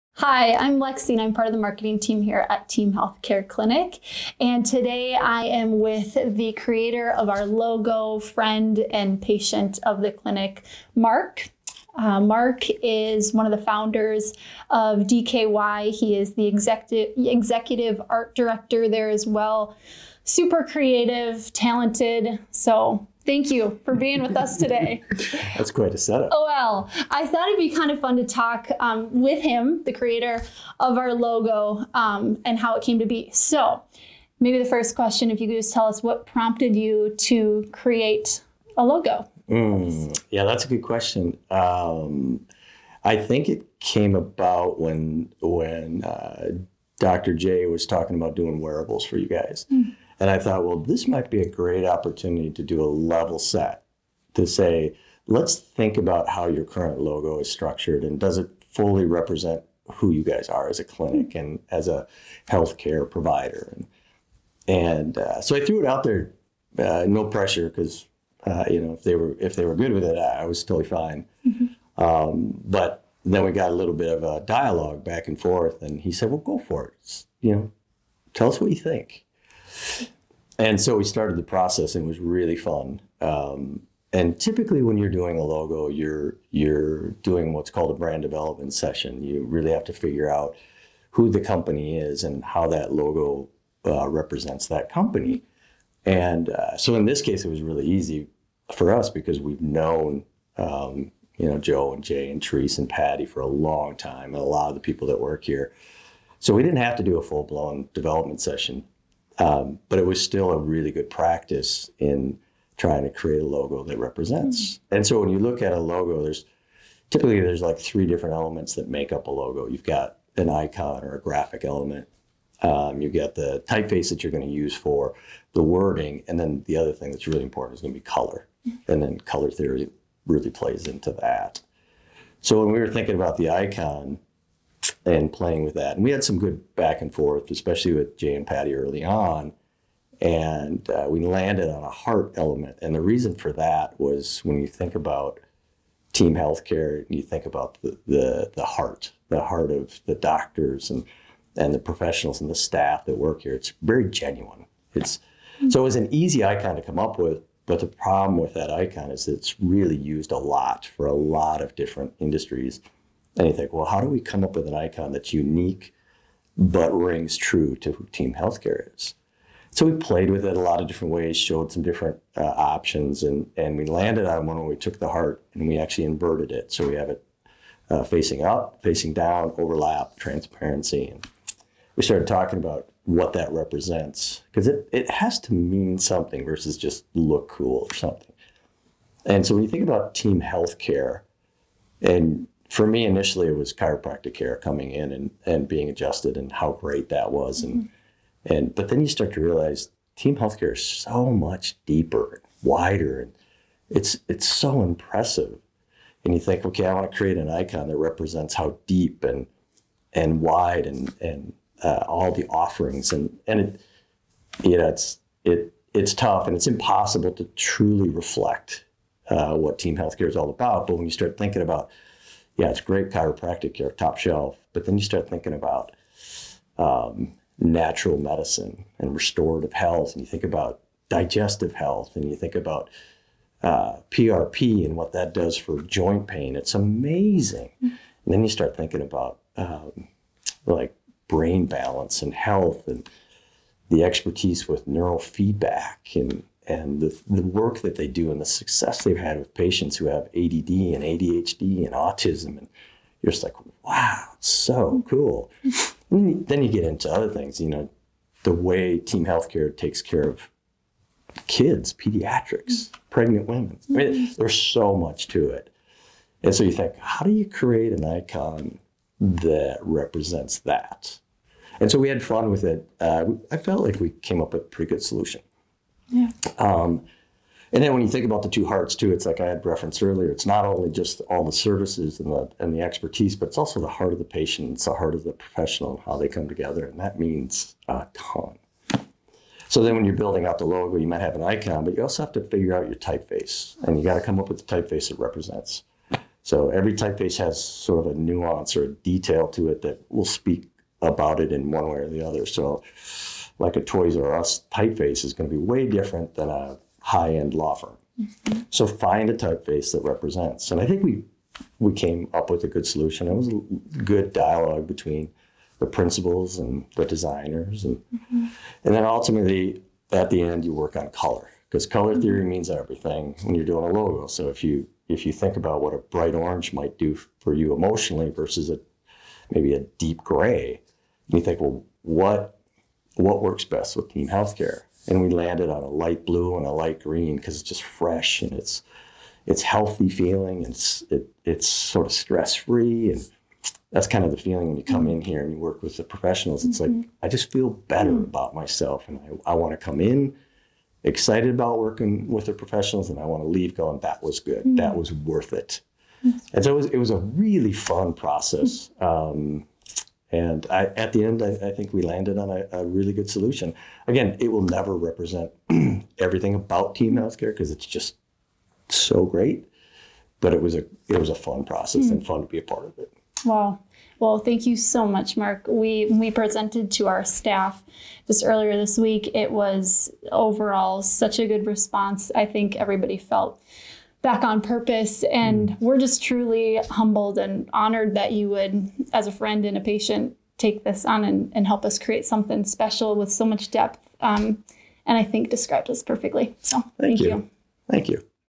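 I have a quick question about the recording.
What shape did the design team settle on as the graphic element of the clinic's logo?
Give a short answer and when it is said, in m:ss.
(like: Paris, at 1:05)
A heart, at 2:21.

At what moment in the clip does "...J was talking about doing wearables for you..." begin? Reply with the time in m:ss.
0:47.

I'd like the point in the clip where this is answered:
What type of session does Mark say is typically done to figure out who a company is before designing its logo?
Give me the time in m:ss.
1:27.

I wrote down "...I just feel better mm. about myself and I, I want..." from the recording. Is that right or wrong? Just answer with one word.
right.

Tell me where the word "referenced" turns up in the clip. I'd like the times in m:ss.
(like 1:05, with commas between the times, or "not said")
4:39.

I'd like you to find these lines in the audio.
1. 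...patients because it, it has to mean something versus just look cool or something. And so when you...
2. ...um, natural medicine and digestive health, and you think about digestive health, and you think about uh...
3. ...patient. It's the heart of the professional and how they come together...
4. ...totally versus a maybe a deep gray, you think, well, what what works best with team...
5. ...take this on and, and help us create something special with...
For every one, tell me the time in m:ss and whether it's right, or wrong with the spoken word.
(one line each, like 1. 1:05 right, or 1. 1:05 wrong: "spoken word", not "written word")
1. 3:03 wrong: "represents", not "patients"
2. 3:46 wrong: "restorative", not "digestive"
3. 4:44 right
4. 5:27 wrong: "emotionally", not "totally"
5. 6:30 right.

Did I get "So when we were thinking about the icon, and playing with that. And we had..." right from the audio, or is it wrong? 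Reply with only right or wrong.
right.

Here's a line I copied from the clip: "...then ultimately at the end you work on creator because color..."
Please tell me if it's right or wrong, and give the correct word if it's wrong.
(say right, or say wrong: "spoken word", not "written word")
wrong: "color", not "creator".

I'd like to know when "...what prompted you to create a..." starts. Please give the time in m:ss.
0:36.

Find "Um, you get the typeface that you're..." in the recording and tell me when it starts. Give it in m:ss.
2:02.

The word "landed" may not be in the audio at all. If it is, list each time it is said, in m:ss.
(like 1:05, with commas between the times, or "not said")
2:21, 2:53, 5:35, 6:02.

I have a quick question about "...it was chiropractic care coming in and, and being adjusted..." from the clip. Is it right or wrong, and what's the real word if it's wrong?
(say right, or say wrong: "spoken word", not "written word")
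right.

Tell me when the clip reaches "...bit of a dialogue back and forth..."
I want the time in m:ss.
1:13.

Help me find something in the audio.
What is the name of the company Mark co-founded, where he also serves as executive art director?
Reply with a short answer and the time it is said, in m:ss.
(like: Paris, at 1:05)
DKY, at 0:15.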